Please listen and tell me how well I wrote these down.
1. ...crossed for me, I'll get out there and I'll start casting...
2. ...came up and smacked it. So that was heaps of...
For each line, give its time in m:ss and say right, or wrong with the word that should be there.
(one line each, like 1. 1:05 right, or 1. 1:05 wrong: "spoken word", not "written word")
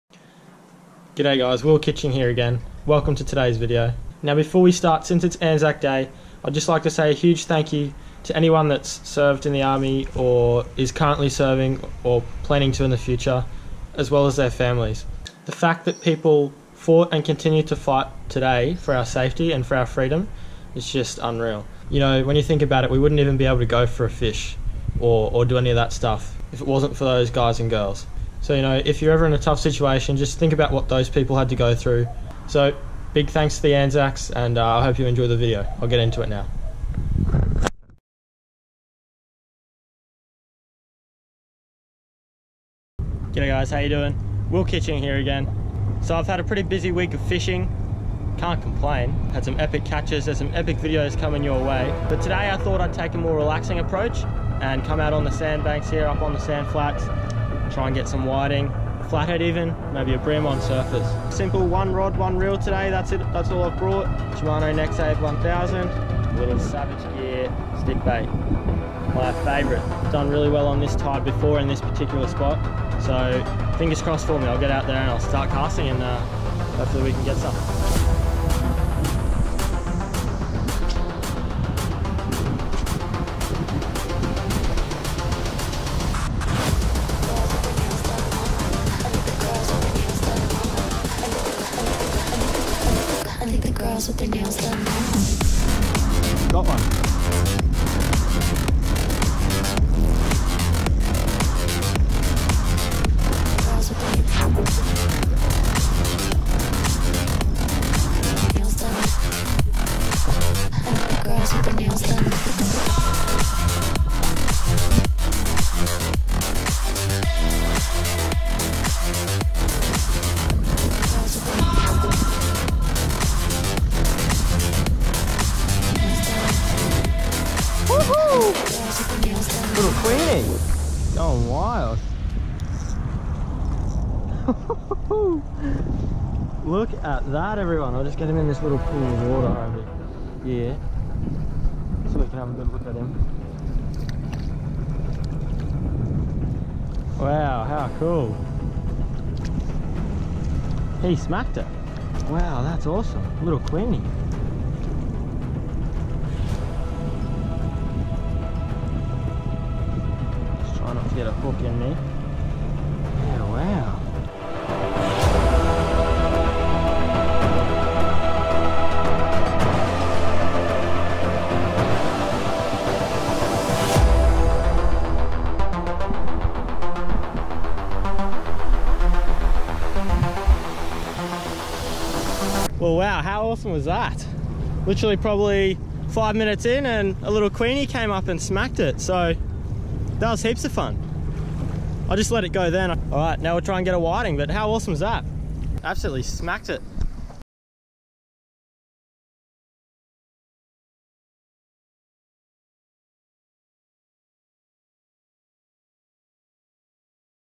1. 1:14 right
2. 3:07 right.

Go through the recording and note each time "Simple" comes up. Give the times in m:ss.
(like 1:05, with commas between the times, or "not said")
1:01.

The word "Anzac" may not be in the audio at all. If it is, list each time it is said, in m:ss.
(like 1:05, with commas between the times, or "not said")
0:05, 0:33.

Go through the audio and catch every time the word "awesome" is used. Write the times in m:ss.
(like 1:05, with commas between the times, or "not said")
2:32, 3:03, 3:14.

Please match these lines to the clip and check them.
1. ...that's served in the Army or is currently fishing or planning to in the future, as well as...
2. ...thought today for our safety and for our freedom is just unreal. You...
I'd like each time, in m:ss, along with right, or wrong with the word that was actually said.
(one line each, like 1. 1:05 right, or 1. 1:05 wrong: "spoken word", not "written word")
1. 0:08 wrong: "serving", not "fishing"
2. 0:17 wrong: "fight", not "thought".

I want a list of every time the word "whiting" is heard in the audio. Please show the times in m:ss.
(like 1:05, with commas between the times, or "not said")
0:58, 3:13.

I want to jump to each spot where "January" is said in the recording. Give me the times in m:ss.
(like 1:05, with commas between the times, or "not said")
not said.